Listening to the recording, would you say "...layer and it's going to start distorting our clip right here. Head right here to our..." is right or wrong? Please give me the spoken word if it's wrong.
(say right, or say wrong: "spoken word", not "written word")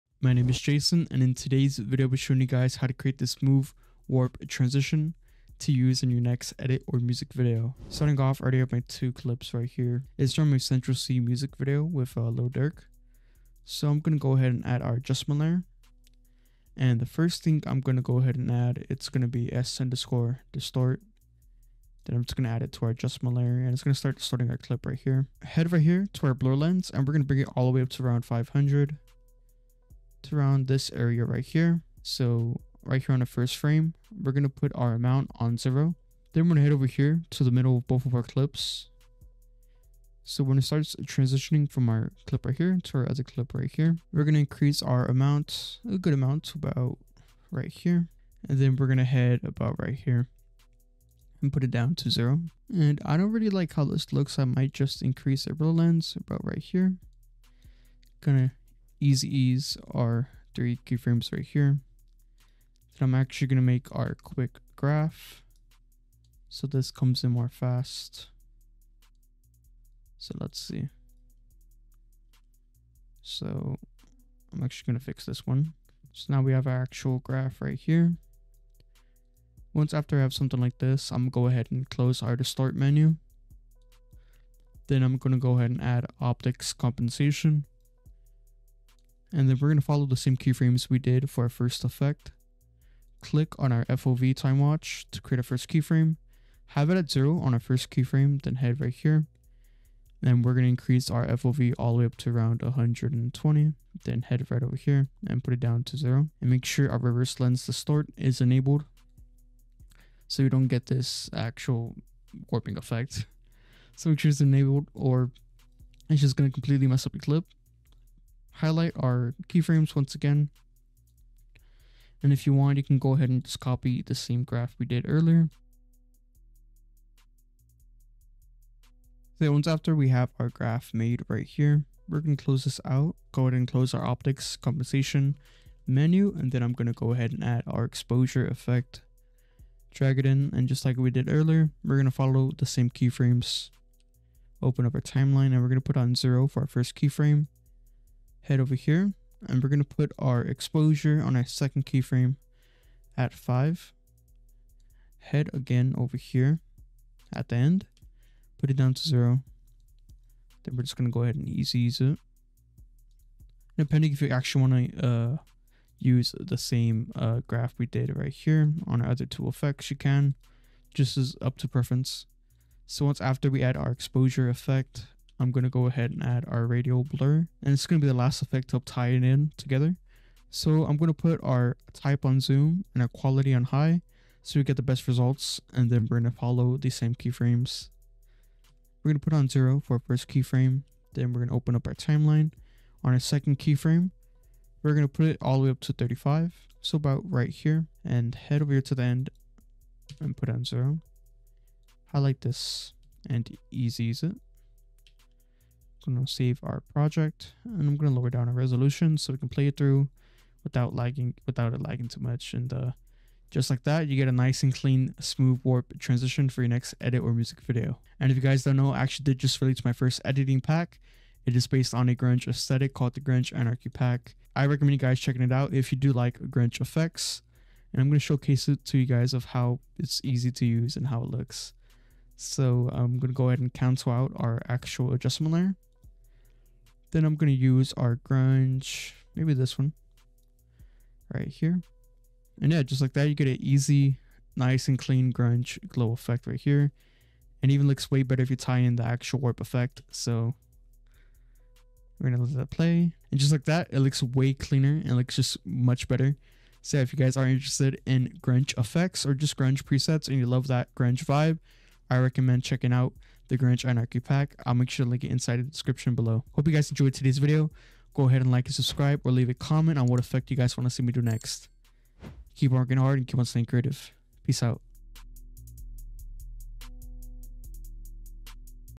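right.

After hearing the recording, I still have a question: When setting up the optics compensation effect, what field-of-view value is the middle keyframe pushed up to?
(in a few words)
120.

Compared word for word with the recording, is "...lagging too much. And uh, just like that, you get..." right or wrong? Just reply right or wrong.
right.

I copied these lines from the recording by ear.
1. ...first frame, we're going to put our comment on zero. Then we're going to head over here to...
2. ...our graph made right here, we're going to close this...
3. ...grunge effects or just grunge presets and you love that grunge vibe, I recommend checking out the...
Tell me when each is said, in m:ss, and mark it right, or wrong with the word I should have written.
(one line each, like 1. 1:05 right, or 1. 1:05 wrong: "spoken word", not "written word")
1. 0:33 wrong: "amount", not "comment"
2. 2:10 right
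3. 4:18 right.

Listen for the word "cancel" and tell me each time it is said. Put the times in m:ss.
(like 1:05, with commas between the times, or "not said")
3:53.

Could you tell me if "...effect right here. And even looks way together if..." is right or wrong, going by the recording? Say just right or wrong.
wrong.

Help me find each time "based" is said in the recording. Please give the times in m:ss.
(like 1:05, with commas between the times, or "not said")
3:41.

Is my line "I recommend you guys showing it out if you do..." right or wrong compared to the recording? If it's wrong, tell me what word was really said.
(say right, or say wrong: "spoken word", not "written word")
wrong: "checking", not "showing".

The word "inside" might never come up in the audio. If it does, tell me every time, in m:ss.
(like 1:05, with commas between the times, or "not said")
4:25.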